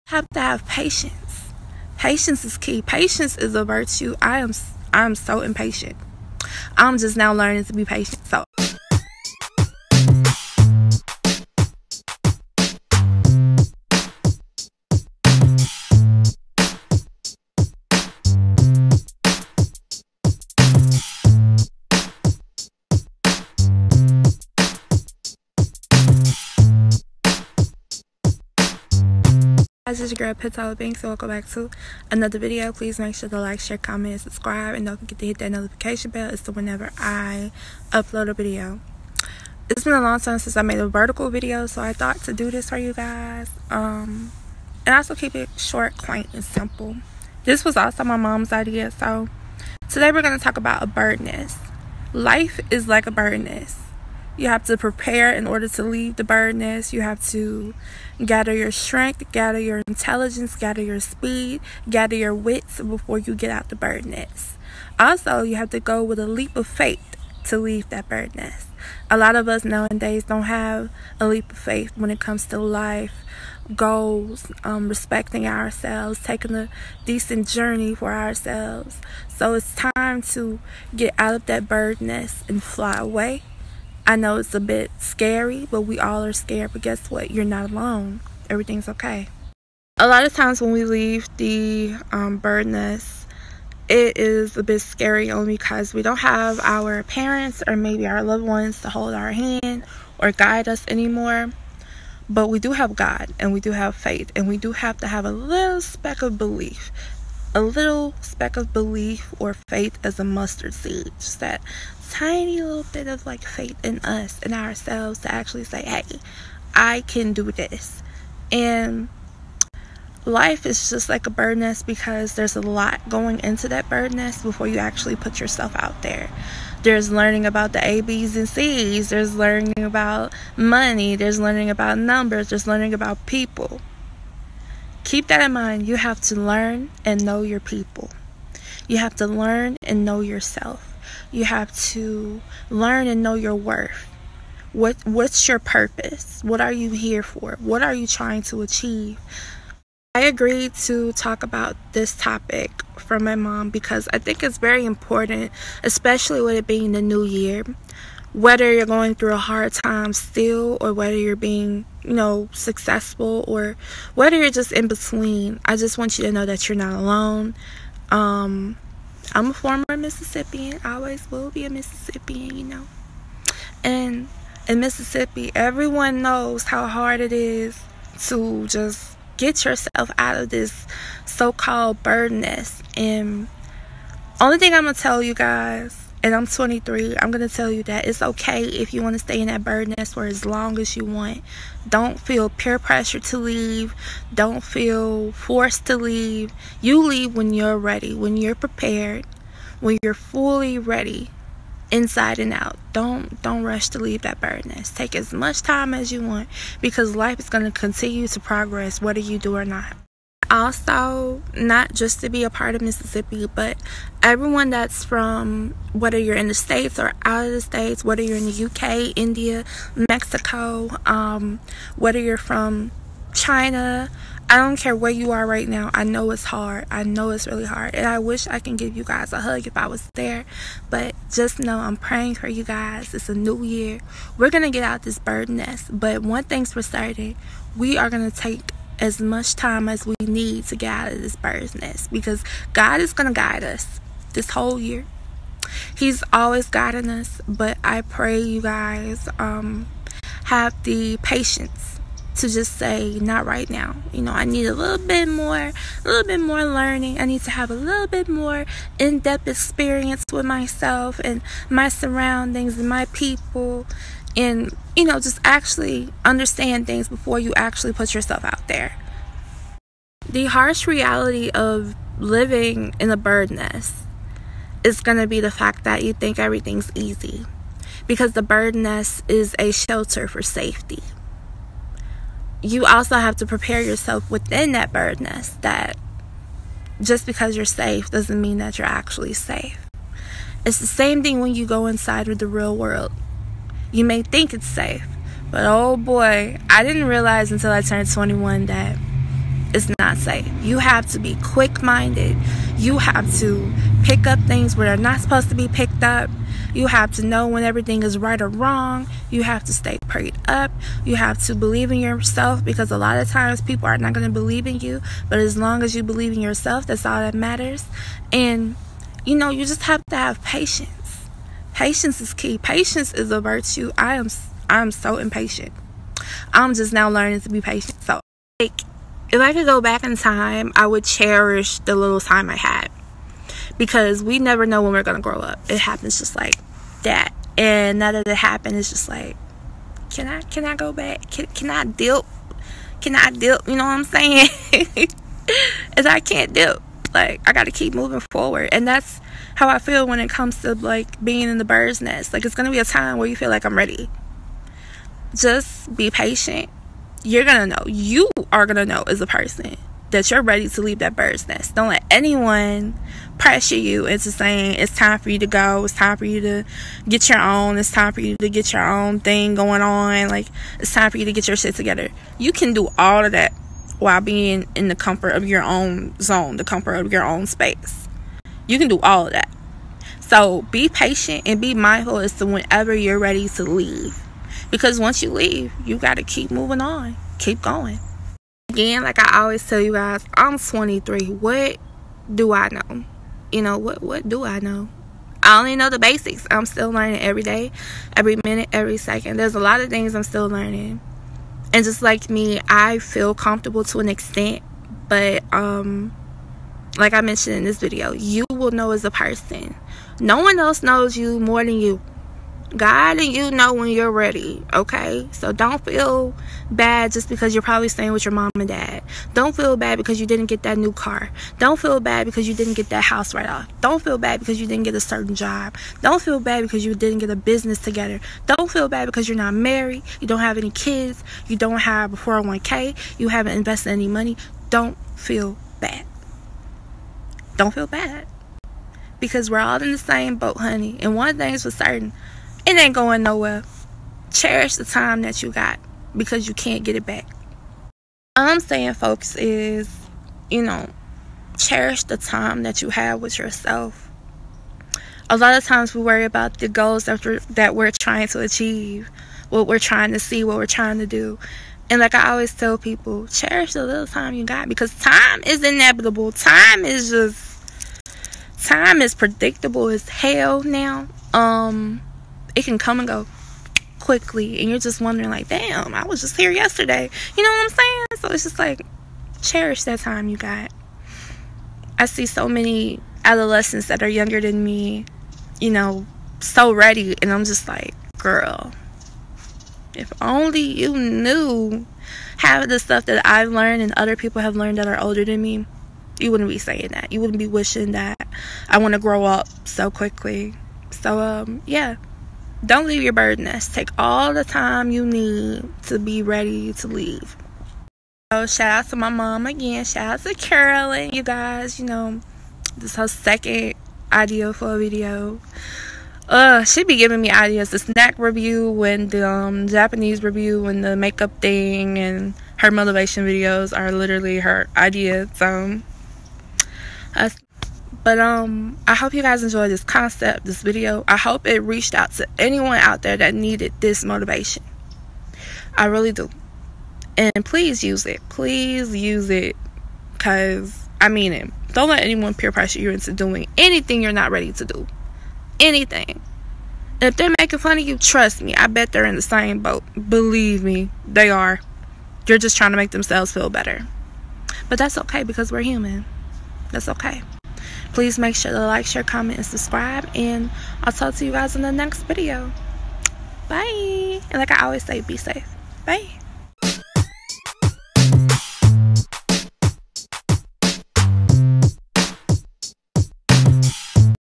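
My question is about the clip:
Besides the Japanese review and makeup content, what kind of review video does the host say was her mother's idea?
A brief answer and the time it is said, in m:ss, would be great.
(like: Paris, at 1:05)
Snack review, at 8:37.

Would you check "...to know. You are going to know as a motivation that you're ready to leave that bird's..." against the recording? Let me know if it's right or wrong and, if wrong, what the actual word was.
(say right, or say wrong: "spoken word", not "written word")
wrong: "person", not "motivation".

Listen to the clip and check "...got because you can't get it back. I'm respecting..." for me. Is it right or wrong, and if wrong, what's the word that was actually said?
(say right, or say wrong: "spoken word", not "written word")
wrong: "saying", not "respecting".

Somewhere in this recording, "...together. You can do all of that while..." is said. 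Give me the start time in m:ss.
6:11.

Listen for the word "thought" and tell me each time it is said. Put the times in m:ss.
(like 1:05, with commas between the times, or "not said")
0:41.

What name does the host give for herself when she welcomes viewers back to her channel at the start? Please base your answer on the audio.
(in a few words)
Pit Tyler Banks.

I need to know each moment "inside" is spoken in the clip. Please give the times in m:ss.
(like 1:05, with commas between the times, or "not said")
3:21, 4:51.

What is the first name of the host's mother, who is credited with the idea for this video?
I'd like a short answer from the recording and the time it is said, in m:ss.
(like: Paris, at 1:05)
Carolyn, at 8:30.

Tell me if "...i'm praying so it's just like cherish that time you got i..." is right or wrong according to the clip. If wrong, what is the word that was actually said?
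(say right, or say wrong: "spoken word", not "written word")
wrong: "saying", not "praying".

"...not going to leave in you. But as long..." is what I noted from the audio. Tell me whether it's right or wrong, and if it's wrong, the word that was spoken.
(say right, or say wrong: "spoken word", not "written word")
wrong: "believe", not "leave".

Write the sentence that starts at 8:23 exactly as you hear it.
Take all the time you need to be ready to leave.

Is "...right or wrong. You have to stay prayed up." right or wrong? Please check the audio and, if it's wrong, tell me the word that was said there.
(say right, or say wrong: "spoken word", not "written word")
right.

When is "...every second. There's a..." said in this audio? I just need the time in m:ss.
6:38.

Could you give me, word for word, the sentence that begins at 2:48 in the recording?
Um, I'm a former Mississippian, I always will be a Mississippian, you know.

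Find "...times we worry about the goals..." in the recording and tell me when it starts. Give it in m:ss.
7:35.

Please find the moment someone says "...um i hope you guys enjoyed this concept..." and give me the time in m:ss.
8:48.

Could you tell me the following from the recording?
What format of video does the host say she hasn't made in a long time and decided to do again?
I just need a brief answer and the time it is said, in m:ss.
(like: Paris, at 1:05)
Vertical video, at 0:40.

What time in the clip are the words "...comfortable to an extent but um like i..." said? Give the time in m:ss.
6:43.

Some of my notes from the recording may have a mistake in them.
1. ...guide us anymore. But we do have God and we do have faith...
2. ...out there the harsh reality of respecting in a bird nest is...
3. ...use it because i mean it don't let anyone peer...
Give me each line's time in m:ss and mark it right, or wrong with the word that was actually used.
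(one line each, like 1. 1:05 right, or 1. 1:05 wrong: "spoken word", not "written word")
1. 1:40 right
2. 4:28 wrong: "living", not "respecting"
3. 8:58 right.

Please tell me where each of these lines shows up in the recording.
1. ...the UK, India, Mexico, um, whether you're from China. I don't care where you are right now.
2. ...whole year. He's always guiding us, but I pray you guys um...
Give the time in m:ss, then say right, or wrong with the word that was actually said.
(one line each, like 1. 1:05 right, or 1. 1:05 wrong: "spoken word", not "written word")
1. 3:38 right
2. 4:04 right.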